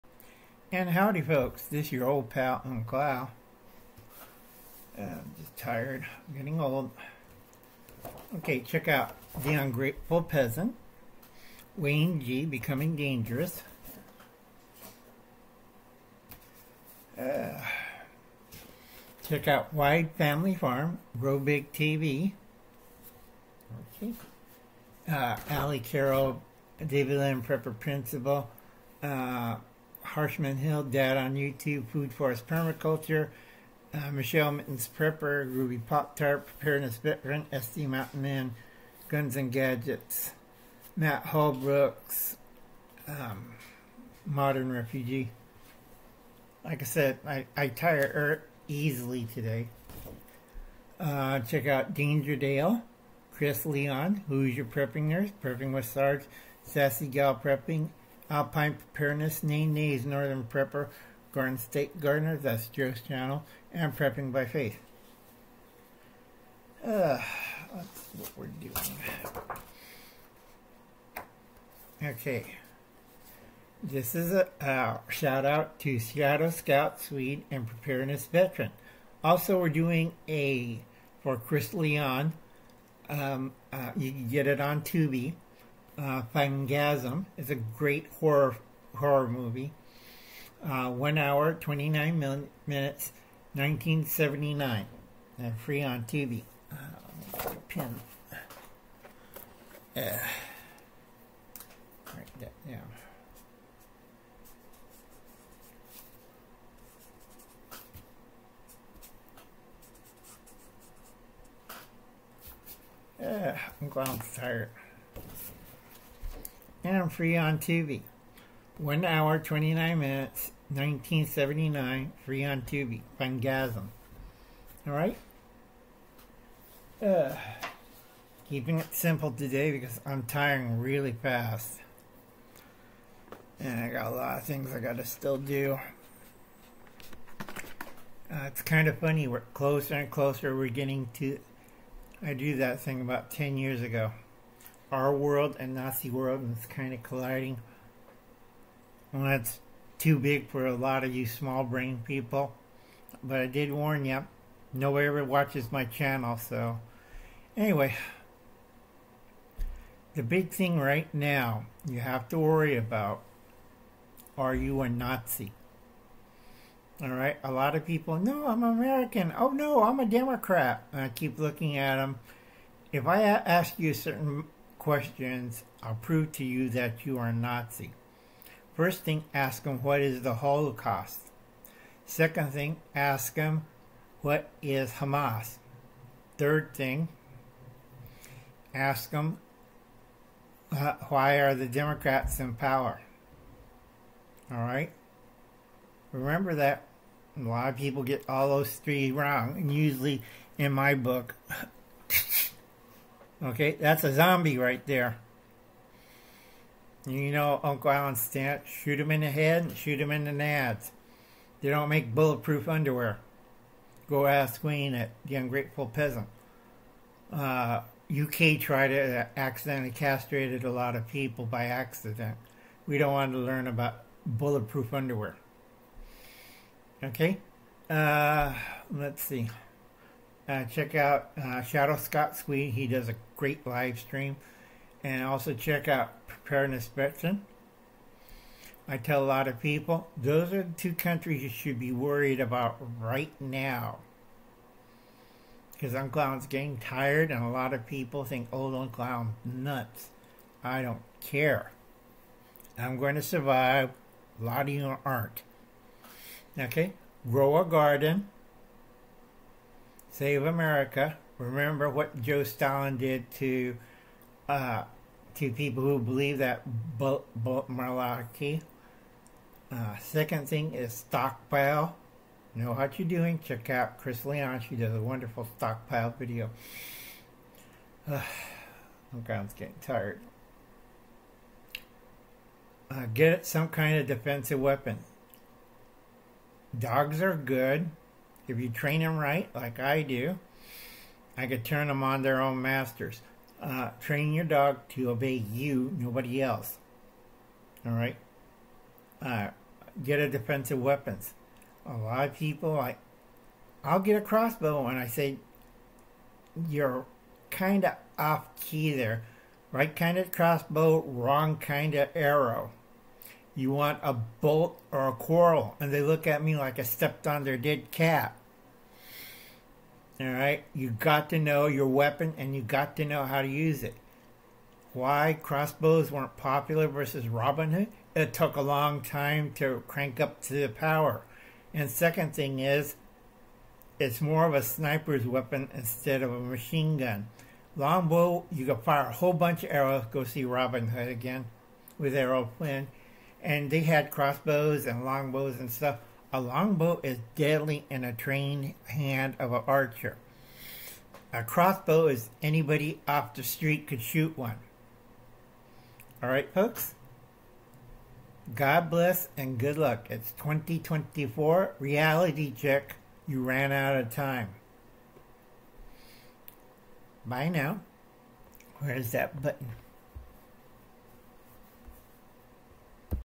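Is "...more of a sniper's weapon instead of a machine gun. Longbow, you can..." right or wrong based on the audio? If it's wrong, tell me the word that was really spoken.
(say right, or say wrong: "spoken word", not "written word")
right.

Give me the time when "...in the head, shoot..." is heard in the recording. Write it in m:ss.
3:29.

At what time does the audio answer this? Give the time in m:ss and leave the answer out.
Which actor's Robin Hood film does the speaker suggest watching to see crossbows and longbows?
5:42.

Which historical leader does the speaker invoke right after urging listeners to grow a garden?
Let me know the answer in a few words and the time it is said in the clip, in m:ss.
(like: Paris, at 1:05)
Joe Stalin, at 4:22.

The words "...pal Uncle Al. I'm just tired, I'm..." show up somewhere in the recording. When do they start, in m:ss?
0:02.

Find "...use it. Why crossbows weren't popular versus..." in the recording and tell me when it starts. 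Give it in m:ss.
5:23.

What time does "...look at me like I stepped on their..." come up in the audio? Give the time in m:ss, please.
5:16.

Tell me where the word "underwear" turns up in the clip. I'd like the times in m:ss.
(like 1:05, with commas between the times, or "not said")
3:32, 3:44.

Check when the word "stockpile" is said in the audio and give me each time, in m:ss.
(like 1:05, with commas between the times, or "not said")
4:30, 4:35.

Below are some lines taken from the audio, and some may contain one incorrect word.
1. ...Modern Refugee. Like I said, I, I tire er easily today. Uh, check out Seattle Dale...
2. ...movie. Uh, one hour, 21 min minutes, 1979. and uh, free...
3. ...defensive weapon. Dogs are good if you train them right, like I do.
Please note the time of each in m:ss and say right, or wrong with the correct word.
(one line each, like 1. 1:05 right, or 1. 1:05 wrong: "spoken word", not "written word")
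1. 0:44 wrong: "Danger", not "Seattle"
2. 1:29 wrong: "29", not "21"
3. 4:44 right.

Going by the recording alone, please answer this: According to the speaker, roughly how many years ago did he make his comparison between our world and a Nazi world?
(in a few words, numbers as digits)
10 years.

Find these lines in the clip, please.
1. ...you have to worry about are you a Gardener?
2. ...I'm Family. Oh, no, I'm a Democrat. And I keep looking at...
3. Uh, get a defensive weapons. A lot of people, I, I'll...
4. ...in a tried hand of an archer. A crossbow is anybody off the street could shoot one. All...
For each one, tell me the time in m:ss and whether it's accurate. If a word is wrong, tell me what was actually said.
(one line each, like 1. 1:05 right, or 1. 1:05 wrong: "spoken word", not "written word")
1. 2:41 wrong: "Nazi", not "Gardener"
2. 2:48 wrong: "American", not "Family"
3. 4:59 right
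4. 5:47 wrong: "trained", not "tried".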